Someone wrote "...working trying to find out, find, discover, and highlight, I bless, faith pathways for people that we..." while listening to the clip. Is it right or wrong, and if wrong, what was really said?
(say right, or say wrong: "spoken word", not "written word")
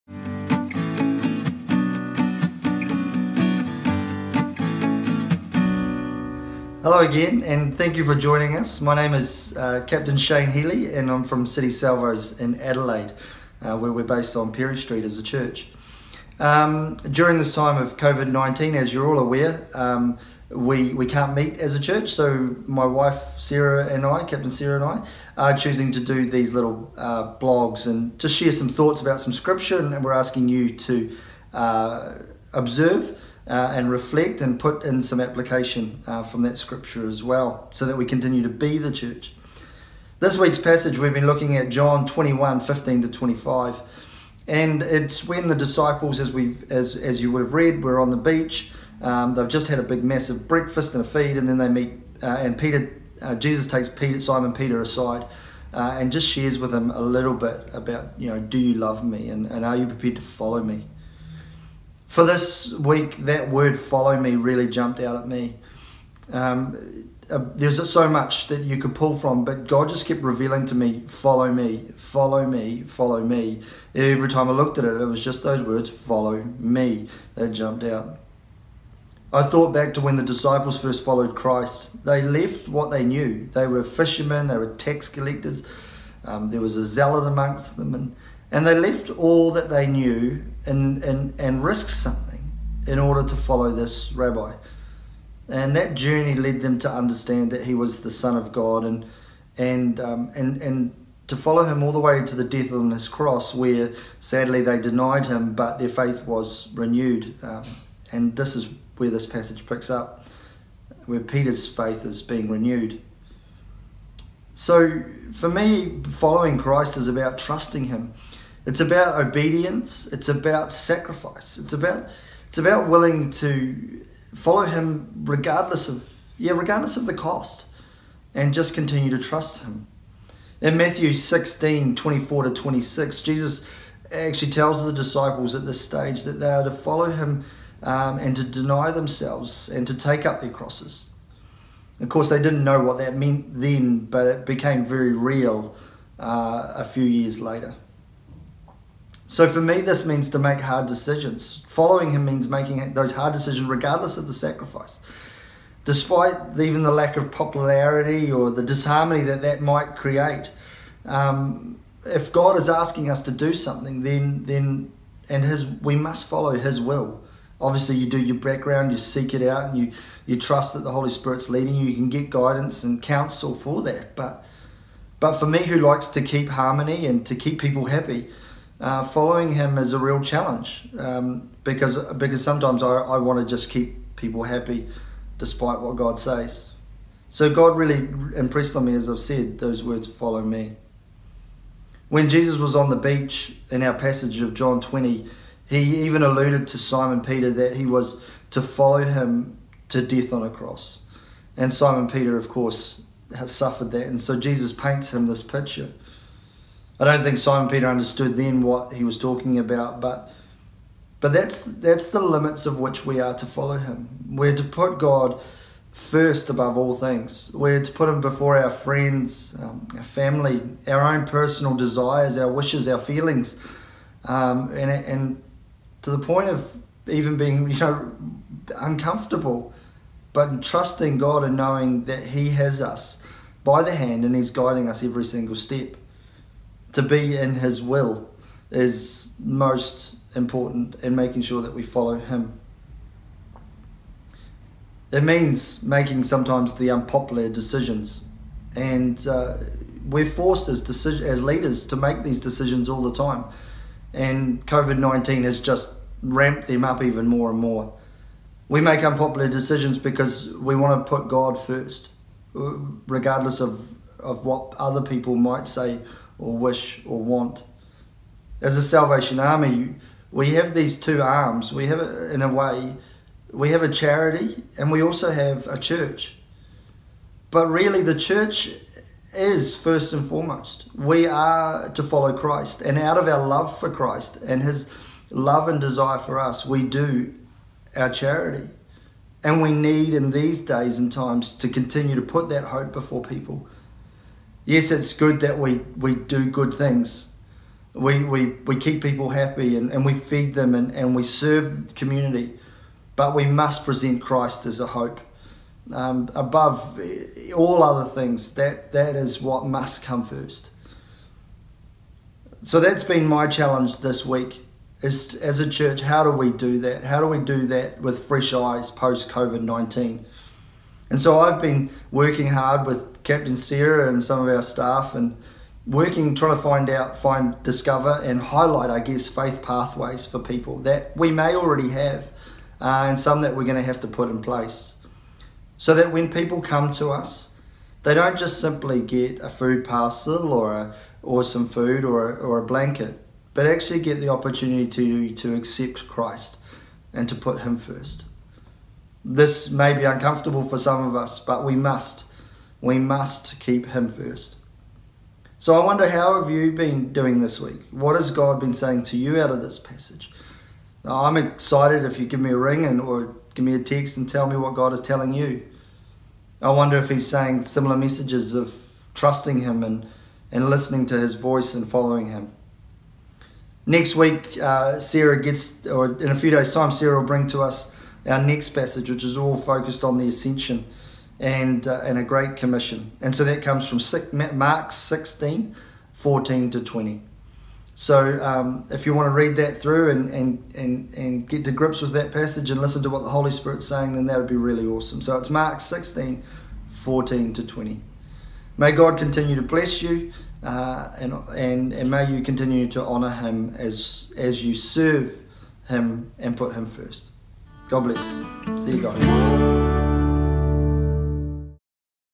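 wrong: "guess", not "bless".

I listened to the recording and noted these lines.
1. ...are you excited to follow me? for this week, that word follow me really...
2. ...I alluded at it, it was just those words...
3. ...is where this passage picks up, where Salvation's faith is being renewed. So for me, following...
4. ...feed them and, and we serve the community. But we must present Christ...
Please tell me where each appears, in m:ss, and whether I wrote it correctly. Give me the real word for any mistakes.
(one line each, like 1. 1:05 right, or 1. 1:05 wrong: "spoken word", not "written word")
1. 0:59 wrong: "prepared", not "excited"
2. 1:14 wrong: "looked", not "alluded"
3. 1:48 wrong: "Peter", not "Salvation"
4. 5:00 right.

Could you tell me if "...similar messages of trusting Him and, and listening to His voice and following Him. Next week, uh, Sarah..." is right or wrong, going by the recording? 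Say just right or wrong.
right.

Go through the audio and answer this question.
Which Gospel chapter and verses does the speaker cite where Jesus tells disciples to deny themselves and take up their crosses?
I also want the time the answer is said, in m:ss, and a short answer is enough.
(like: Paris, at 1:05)
Matthew 16:24-26, at 2:10.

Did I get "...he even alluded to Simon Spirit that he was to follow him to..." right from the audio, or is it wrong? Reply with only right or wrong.
wrong.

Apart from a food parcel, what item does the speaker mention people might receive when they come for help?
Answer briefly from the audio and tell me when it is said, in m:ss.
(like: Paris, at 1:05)
a blanket, at 5:42.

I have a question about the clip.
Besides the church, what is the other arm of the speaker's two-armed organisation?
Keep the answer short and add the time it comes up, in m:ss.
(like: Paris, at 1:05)
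a charity, at 4:33.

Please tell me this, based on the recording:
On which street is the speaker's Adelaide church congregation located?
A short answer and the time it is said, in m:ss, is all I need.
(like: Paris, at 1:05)
Pirie Street, at 0:14.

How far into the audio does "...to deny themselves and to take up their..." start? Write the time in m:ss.
2:18.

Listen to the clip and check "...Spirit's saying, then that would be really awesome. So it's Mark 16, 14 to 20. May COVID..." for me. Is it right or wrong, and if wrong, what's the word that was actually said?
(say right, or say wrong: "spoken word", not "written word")
wrong: "God", not "COVID".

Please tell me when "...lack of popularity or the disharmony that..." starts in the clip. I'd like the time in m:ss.
2:36.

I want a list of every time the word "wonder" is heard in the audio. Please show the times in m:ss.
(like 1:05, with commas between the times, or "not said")
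5:55, 6:06.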